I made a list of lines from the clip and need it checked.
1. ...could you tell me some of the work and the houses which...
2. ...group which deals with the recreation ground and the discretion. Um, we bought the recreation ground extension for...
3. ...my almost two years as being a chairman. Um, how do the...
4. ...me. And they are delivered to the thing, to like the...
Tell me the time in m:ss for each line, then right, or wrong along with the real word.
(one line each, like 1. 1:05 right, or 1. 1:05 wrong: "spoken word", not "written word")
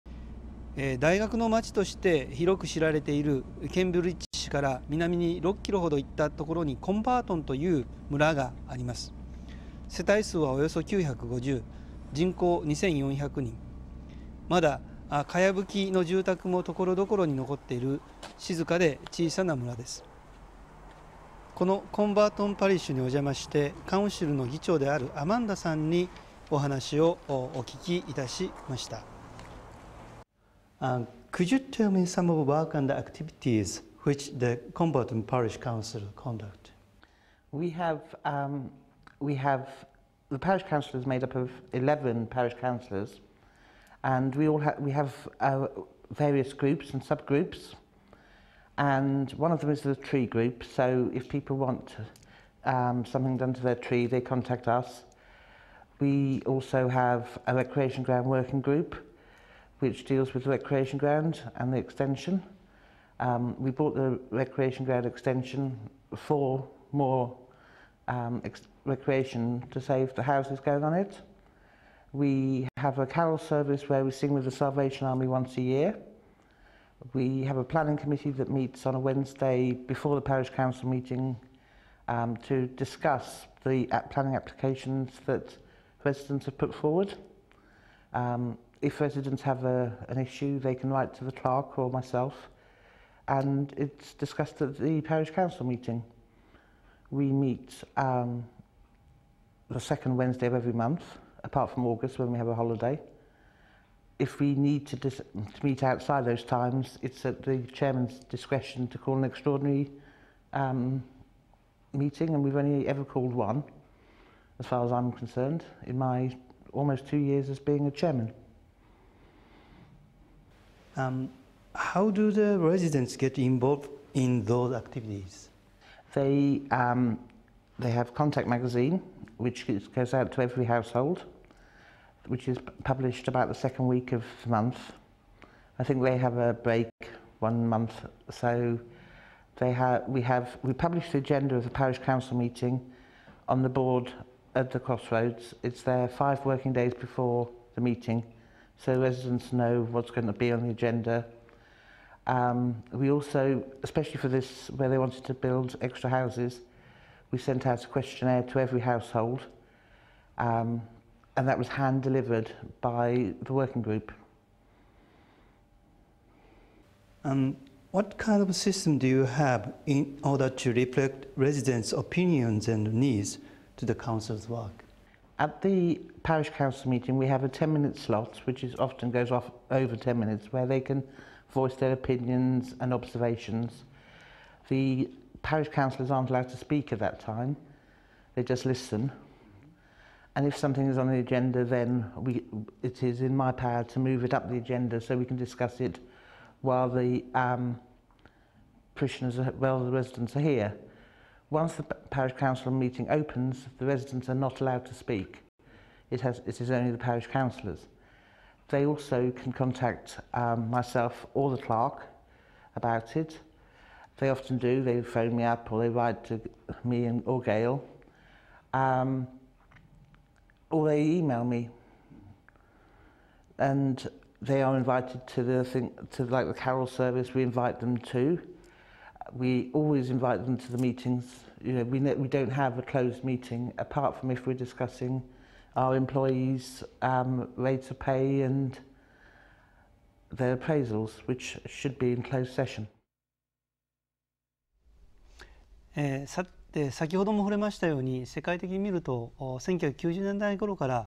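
1. 0:31 wrong: "activities", not "houses"
2. 0:58 wrong: "extension", not "discretion"
3. 1:55 right
4. 3:41 wrong: "invited", not "delivered".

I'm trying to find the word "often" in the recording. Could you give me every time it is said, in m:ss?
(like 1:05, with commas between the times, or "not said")
2:58, 3:34.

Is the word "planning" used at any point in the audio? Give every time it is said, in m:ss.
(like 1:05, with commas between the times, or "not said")
1:17, 1:24.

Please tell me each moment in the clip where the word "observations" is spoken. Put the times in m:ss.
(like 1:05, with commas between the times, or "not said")
3:02.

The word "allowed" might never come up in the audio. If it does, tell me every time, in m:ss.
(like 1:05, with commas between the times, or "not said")
3:06, 3:24.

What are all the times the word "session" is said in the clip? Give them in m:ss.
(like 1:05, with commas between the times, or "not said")
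4:02.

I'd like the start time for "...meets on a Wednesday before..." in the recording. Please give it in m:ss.
1:18.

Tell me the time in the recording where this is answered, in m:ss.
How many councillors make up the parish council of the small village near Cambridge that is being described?
0:41.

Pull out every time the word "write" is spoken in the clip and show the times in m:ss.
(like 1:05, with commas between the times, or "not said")
1:30, 3:35.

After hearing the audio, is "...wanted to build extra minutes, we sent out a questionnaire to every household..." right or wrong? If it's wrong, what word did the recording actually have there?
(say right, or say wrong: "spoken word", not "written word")
wrong: "houses", not "minutes".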